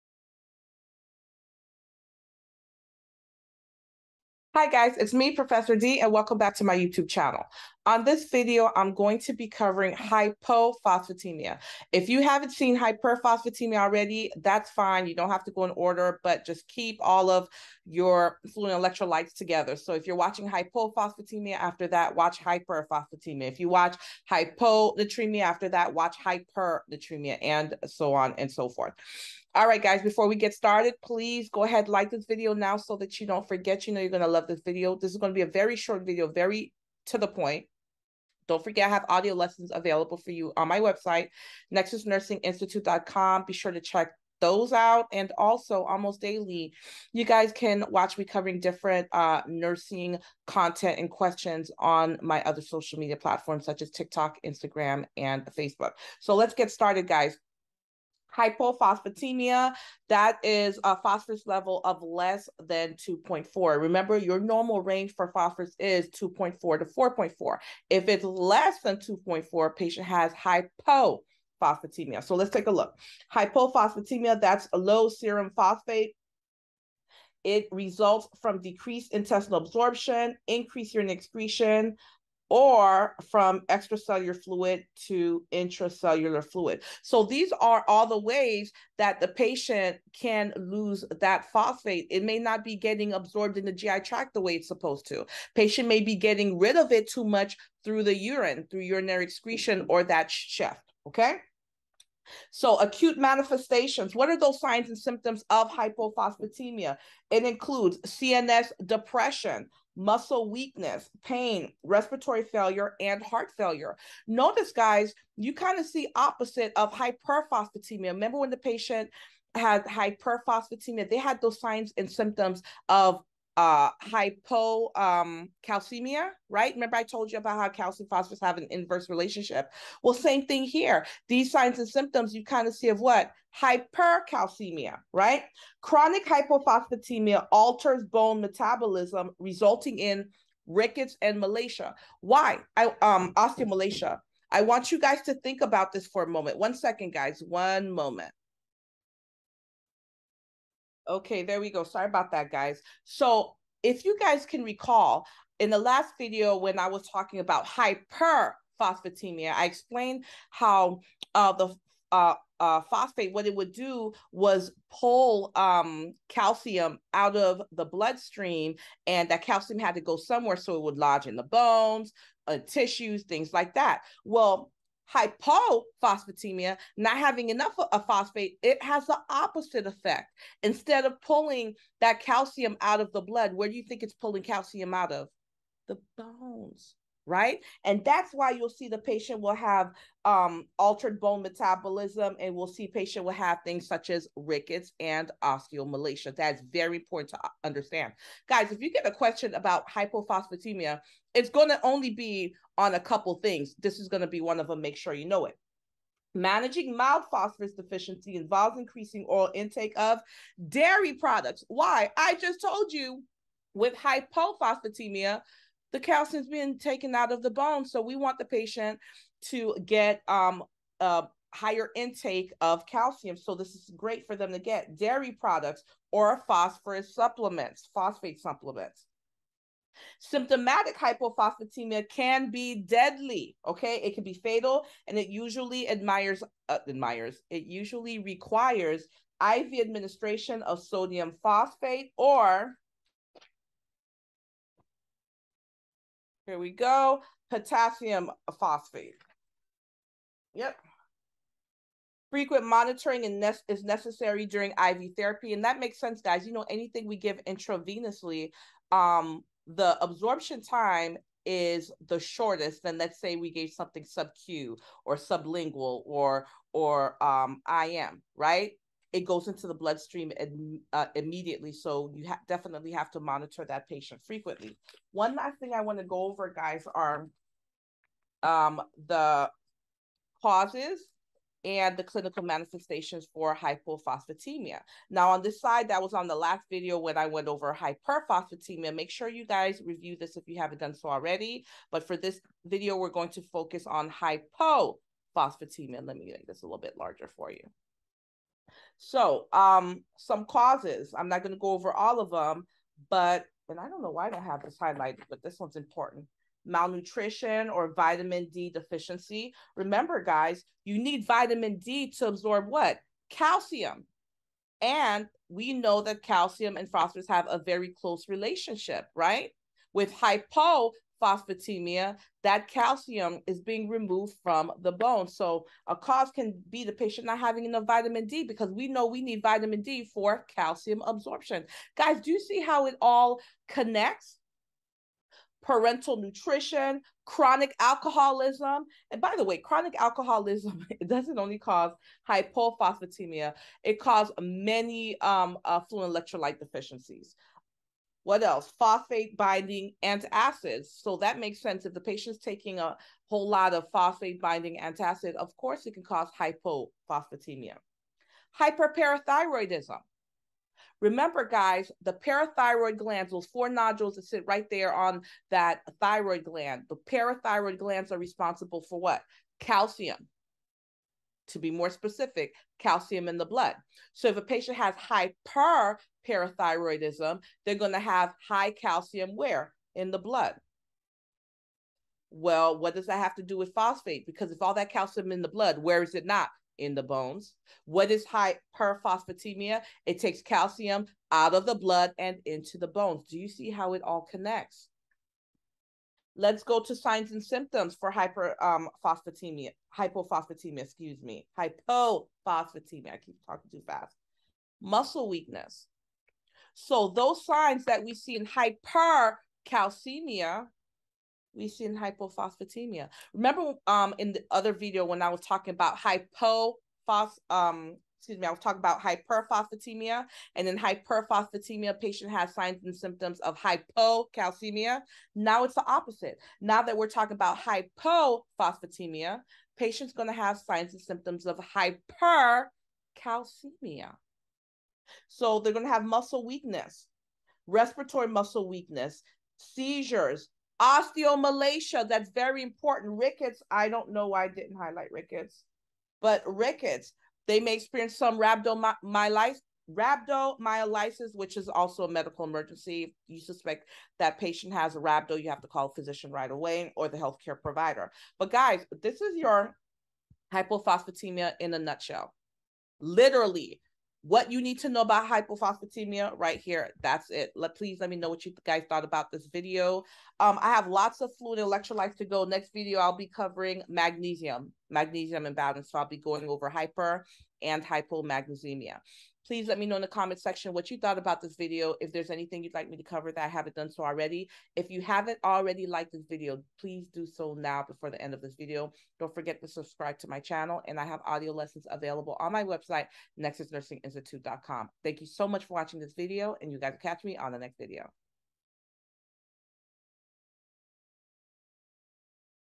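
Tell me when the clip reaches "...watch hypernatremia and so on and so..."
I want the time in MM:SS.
00:25.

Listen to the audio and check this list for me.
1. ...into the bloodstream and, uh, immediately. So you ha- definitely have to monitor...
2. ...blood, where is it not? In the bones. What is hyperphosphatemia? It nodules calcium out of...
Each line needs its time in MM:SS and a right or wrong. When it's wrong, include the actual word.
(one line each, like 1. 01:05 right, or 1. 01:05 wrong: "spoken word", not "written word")
1. 04:29 right
2. 06:25 wrong: "takes", not "nodules".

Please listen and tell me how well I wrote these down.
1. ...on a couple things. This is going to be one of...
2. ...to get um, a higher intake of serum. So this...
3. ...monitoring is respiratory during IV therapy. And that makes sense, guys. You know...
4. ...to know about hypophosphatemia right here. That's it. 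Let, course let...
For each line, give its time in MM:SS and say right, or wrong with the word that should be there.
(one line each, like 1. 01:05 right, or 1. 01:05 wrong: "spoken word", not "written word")
1. 03:22 right
2. 03:39 wrong: "calcium", not "serum"
3. 04:12 wrong: "necessary", not "respiratory"
4. 07:44 wrong: "please", not "course".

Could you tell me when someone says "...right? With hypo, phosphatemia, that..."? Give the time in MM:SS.
05:19.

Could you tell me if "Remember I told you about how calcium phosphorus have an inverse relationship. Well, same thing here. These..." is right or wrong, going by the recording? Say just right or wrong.
right.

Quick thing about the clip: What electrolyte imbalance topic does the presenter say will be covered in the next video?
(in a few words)
Magnesium imbalance.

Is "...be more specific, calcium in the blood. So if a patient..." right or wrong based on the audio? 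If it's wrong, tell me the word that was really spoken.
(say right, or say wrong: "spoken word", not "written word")
right.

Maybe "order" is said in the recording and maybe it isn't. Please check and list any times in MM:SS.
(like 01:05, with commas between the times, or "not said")
00:15.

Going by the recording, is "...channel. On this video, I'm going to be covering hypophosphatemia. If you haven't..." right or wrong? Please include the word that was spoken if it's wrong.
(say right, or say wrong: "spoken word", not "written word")
right.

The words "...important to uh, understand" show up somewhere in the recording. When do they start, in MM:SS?
03:16.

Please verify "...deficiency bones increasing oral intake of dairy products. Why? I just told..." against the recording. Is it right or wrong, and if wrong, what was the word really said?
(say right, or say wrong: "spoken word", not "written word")
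wrong: "involves", not "bones".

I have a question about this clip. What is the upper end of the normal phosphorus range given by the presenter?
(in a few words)
4.4.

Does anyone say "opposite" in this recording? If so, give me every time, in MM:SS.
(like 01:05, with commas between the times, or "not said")
01:56, 02:59, 07:05.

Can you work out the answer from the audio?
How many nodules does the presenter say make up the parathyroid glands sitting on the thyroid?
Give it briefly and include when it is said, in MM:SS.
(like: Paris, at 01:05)
4, at 06:03.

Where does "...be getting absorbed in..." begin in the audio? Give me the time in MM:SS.
01:32.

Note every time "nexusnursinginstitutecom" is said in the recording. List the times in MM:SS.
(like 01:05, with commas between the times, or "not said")
00:41, 08:13.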